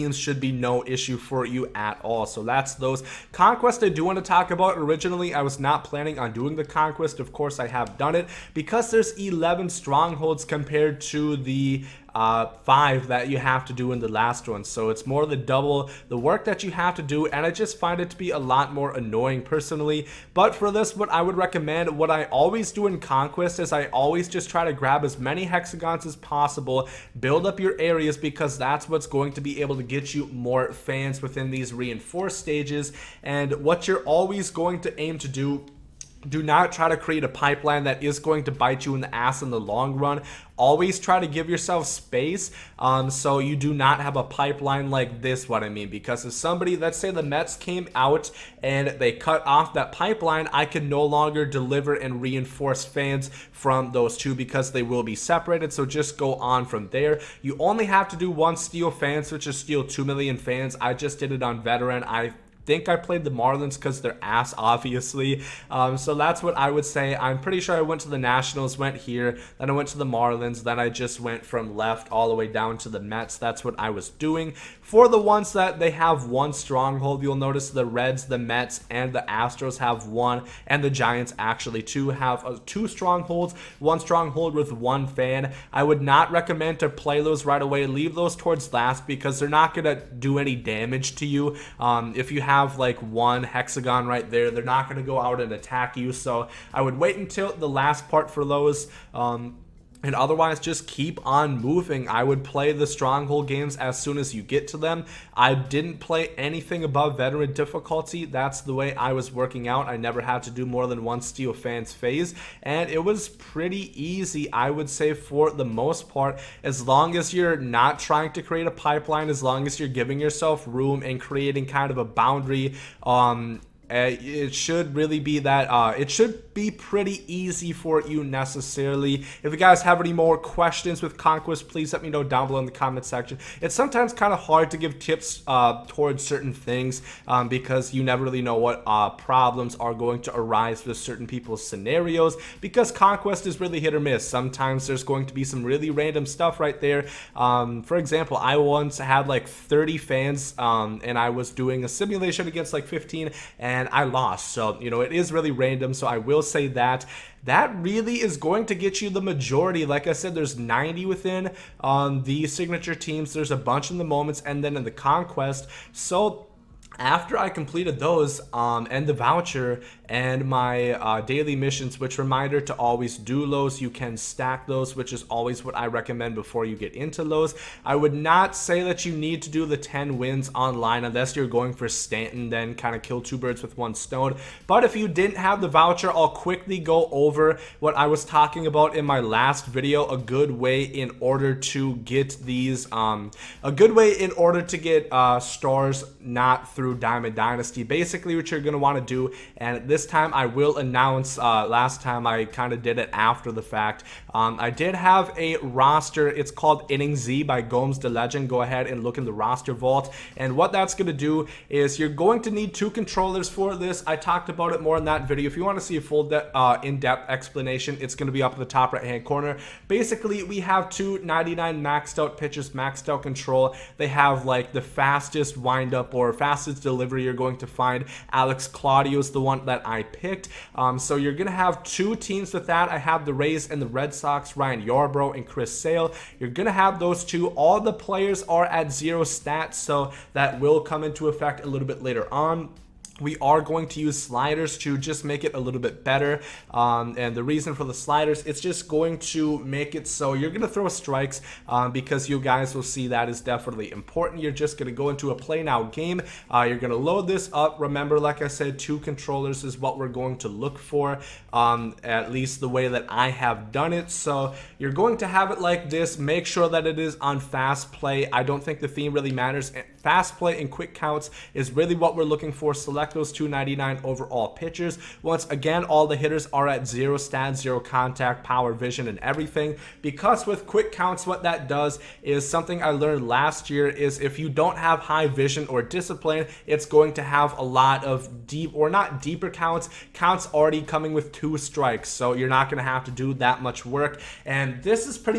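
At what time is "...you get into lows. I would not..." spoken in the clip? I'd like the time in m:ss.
2:56.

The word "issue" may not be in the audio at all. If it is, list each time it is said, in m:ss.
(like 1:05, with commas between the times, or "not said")
0:00.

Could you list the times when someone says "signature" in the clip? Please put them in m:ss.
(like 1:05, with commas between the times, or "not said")
2:42.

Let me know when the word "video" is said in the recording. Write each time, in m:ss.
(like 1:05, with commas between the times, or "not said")
3:09, 3:35.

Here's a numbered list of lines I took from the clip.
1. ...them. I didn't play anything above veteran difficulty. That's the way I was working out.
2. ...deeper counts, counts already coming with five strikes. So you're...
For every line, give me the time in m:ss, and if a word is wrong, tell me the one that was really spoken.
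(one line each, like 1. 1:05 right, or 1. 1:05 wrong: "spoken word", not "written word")
1. 1:44 right
2. 4:49 wrong: "two", not "five".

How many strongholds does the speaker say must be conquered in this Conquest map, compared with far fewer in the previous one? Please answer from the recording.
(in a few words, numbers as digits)
11.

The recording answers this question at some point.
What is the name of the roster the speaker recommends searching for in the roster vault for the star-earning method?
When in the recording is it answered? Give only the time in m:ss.
3:26.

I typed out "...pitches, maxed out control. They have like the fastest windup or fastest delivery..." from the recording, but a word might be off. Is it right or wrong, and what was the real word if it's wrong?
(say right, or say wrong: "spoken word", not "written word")
right.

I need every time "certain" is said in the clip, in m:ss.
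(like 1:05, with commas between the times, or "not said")
2:16, 2:20.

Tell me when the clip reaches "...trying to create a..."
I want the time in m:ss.
1:57.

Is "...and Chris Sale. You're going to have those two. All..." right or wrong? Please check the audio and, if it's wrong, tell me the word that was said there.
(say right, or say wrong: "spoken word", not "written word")
right.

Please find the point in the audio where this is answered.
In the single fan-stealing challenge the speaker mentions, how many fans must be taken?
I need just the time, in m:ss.
0:59.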